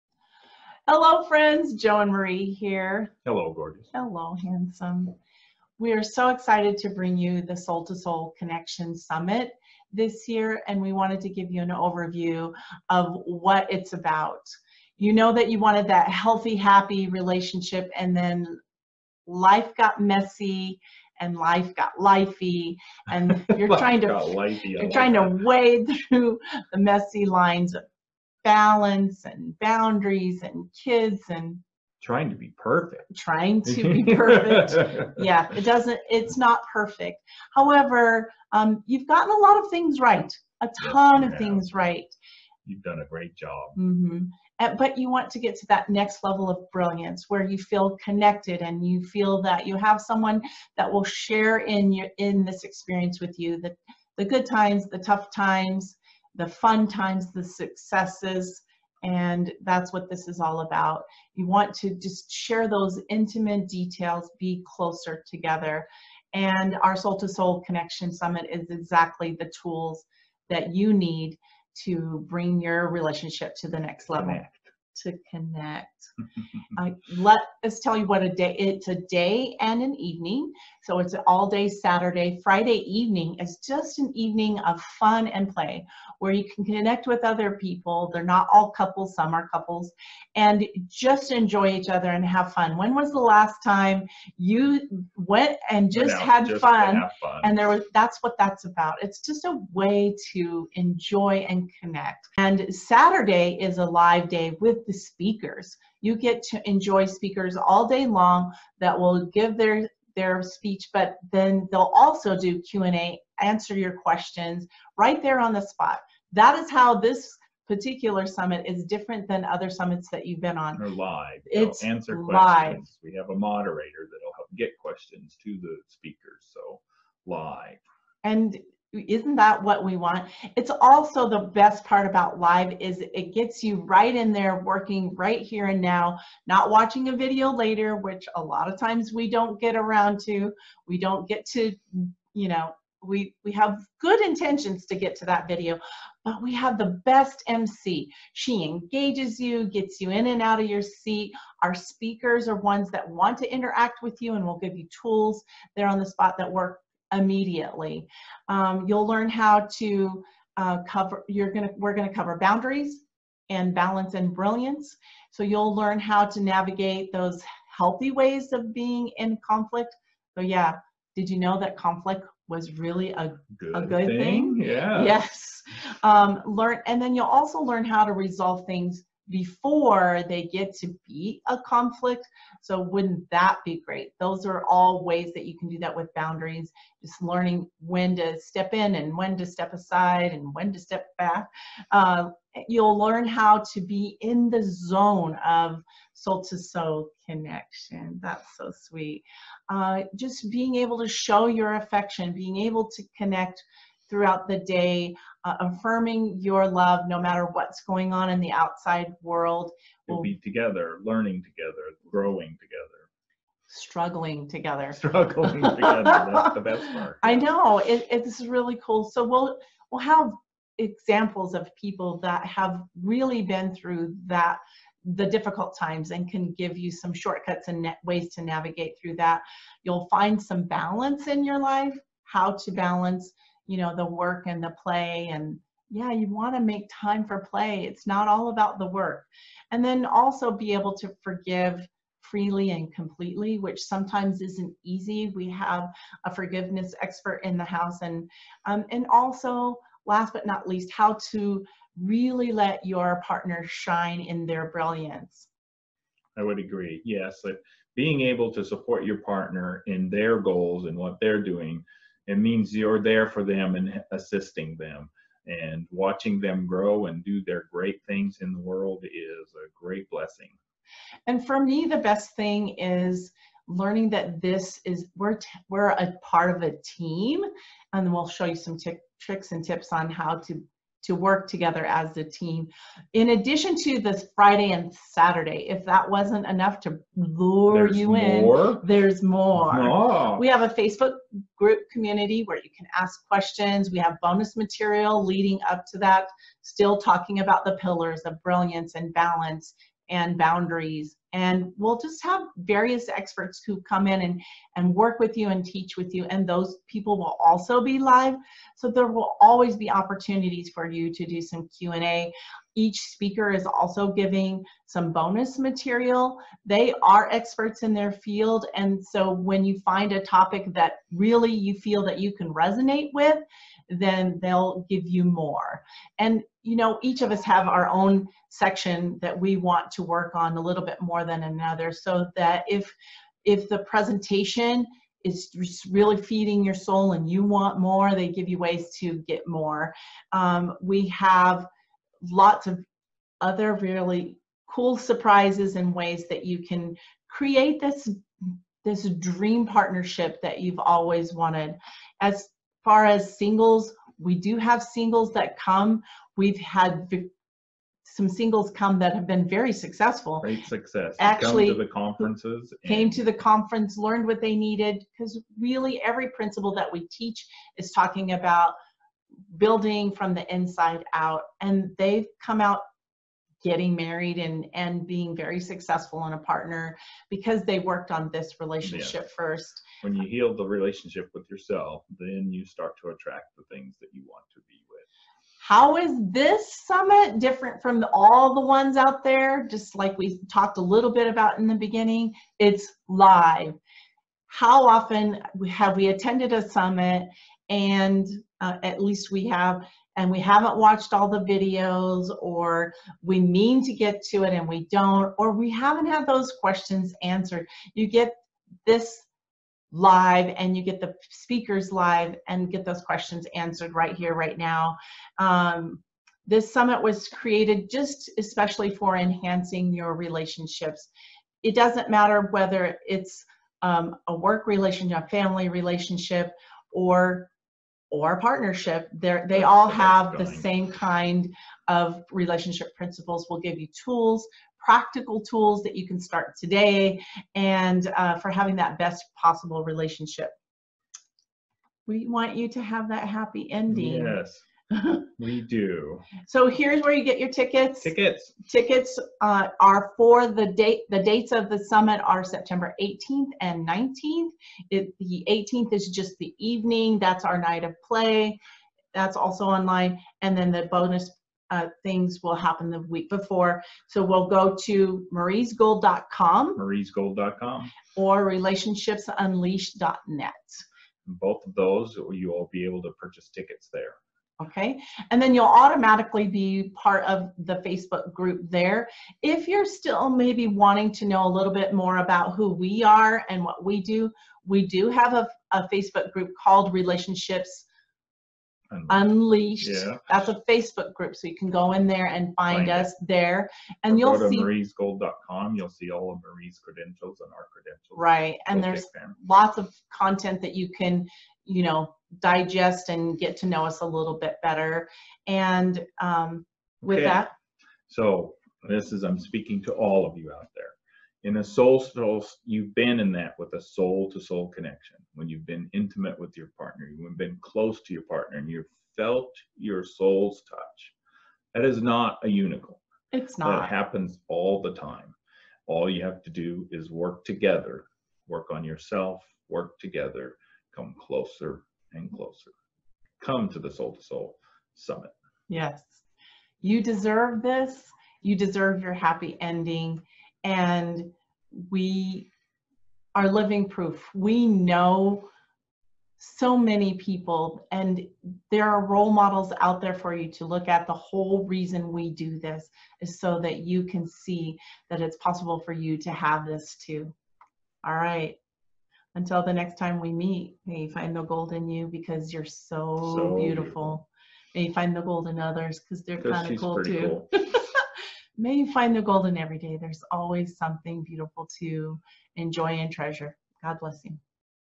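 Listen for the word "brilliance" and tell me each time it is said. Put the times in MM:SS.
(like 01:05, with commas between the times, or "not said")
00:46, 02:44, 04:14, 04:58.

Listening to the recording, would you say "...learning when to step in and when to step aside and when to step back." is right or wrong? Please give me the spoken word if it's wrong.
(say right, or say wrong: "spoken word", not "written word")
right.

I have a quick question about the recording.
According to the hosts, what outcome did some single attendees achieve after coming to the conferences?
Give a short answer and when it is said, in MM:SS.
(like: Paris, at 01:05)
getting married, at 06:13.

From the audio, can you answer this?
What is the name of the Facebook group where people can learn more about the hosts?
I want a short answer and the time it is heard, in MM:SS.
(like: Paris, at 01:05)
Relationships Unleashed, at 08:06.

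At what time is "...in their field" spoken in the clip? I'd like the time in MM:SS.
05:17.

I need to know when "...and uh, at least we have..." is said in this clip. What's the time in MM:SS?
06:37.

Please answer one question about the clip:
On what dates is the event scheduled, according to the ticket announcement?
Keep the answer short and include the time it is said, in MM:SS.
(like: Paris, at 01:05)
September 18th and 19th, at 07:32.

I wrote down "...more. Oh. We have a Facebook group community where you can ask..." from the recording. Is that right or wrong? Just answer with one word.
right.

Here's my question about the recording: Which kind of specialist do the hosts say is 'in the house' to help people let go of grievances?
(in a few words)
forgiveness expert.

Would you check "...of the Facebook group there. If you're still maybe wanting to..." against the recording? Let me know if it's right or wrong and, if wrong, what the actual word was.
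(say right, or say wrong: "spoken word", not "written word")
right.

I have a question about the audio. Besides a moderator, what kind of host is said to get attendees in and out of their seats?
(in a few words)
MC.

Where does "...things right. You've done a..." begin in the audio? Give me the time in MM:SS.
00:41.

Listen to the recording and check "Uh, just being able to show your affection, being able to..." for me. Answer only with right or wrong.
right.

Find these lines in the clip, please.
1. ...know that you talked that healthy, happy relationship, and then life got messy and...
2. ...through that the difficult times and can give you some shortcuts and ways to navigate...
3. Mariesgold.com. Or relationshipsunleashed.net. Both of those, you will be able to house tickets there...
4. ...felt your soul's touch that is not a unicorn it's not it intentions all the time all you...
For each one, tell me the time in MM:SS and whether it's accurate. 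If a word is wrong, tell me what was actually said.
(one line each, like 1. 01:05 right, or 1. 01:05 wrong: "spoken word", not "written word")
1. 00:15 wrong: "wanted", not "talked"
2. 03:43 right
3. 07:46 wrong: "purchase", not "house"
4. 08:39 wrong: "happens", not "intentions".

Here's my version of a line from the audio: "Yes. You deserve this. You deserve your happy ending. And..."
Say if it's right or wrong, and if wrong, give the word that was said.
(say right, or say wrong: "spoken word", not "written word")
right.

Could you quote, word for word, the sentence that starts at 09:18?
All right until the next time we meet, may you find the gold in you because you're so, so beautiful.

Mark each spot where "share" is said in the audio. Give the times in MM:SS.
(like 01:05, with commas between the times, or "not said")
00:51, 01:02.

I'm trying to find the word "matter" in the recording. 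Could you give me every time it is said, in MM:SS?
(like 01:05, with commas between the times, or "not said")
03:27, 07:02.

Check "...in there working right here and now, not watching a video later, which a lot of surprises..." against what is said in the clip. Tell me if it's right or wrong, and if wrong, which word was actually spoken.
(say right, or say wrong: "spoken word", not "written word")
wrong: "times", not "surprises".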